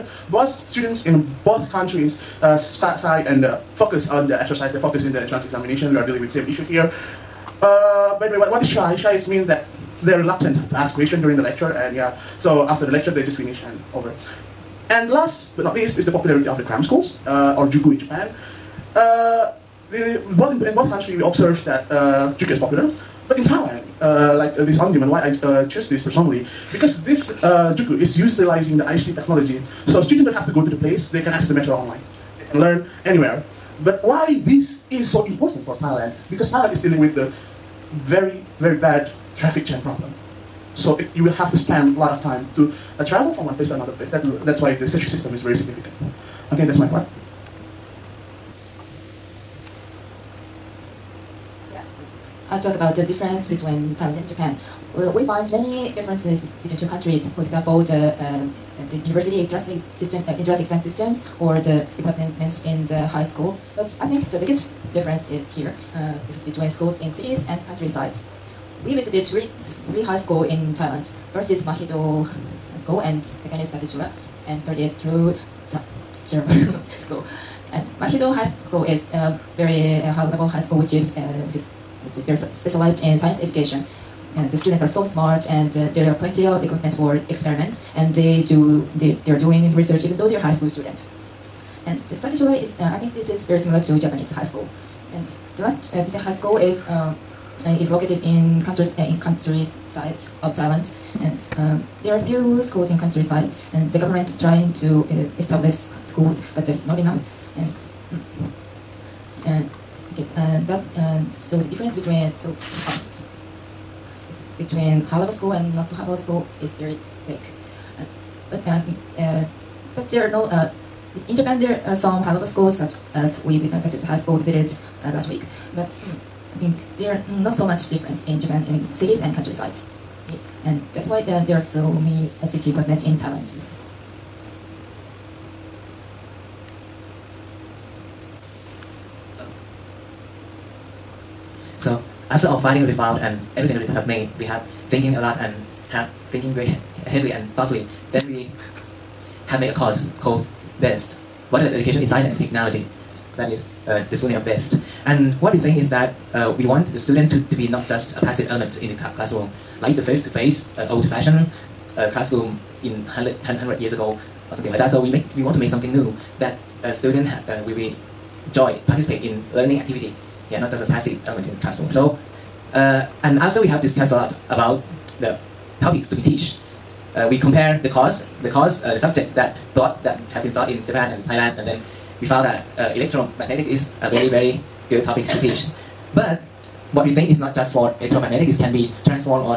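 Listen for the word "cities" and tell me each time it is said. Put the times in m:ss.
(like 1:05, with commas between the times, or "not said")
1:07, 2:08.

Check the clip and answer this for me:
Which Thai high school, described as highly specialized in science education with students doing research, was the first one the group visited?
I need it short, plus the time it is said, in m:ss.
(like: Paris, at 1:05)
Mahidol School, at 1:11.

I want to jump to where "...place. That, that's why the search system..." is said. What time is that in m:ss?
0:43.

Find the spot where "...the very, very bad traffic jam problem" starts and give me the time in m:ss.
0:37.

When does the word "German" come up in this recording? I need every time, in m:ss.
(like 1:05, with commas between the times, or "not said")
1:16.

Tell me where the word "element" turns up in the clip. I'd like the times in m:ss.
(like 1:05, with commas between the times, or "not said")
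2:38, 2:51.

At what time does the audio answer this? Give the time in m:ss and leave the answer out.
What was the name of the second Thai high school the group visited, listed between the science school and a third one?
1:13.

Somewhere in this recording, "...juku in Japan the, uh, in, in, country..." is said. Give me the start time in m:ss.
0:17.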